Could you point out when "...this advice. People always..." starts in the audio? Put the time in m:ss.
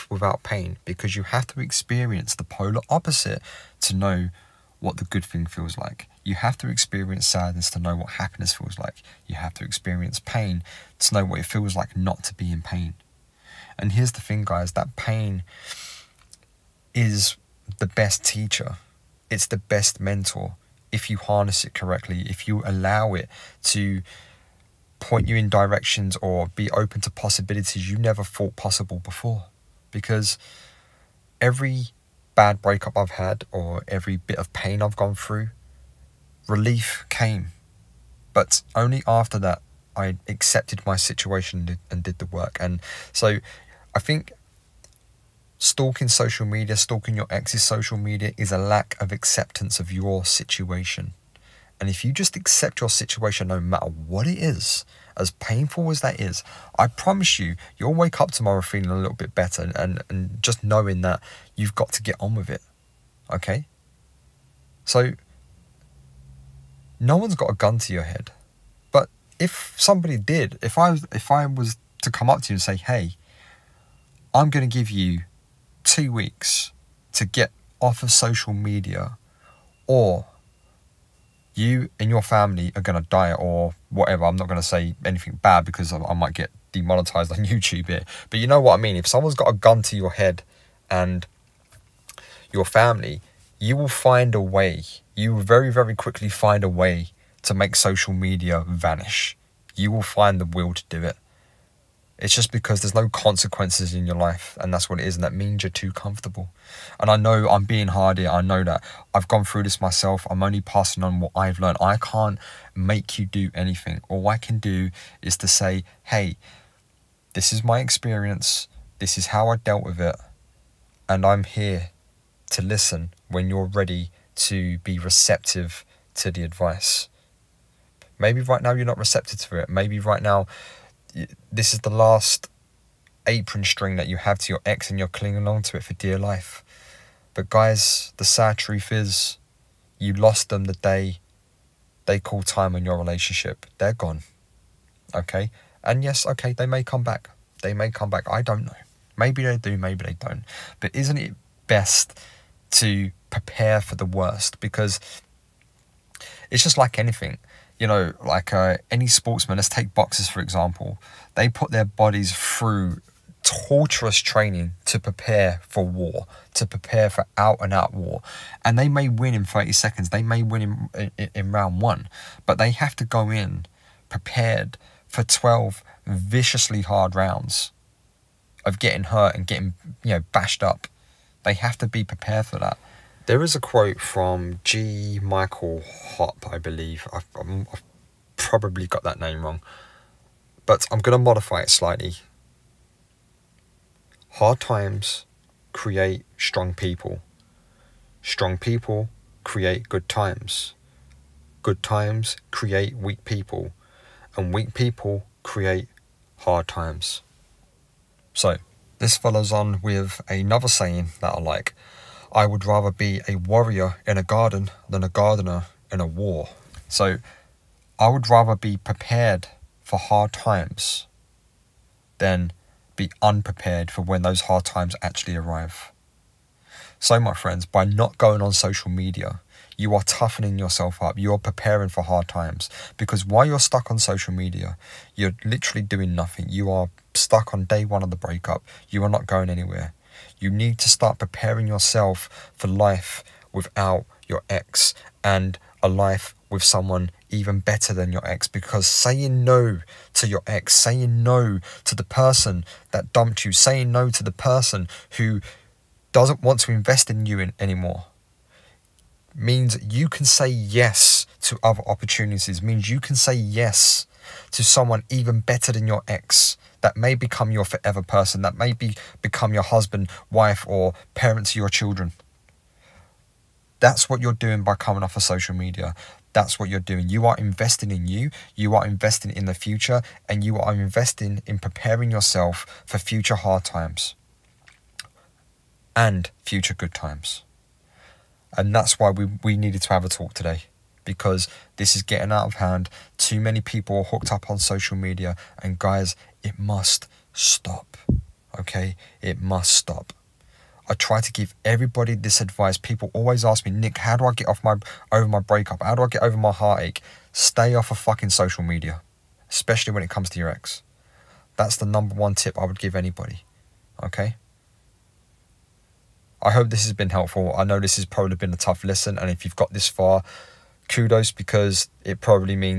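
5:02.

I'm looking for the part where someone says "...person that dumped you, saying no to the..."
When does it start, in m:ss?
4:12.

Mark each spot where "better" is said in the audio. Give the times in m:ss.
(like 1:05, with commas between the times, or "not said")
0:59, 4:07, 4:25.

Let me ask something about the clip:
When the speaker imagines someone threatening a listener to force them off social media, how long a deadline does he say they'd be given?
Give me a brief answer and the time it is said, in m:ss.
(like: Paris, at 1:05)
2 weeks, at 1:15.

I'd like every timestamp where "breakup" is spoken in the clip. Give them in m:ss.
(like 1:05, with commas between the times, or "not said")
0:32, 3:58, 5:05.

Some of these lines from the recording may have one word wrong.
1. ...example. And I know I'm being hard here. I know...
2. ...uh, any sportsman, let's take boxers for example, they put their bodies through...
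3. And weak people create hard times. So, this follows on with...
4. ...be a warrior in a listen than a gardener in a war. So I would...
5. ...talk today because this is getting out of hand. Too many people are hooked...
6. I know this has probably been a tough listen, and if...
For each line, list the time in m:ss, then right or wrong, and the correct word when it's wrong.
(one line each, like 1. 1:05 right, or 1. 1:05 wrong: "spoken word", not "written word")
1. 1:45 wrong: "comfortable", not "example"
2. 2:38 right
3. 3:24 right
4. 3:32 wrong: "garden", not "listen"
5. 4:50 right
6. 5:17 right.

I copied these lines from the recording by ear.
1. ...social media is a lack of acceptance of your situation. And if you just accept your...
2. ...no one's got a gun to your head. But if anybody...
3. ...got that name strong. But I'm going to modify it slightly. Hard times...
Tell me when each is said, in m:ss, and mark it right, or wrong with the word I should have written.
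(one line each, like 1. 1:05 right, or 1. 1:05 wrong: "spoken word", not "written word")
1. 0:47 right
2. 1:06 wrong: "somebody", not "anybody"
3. 3:08 wrong: "wrong", not "strong".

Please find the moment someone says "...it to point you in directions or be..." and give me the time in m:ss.
0:23.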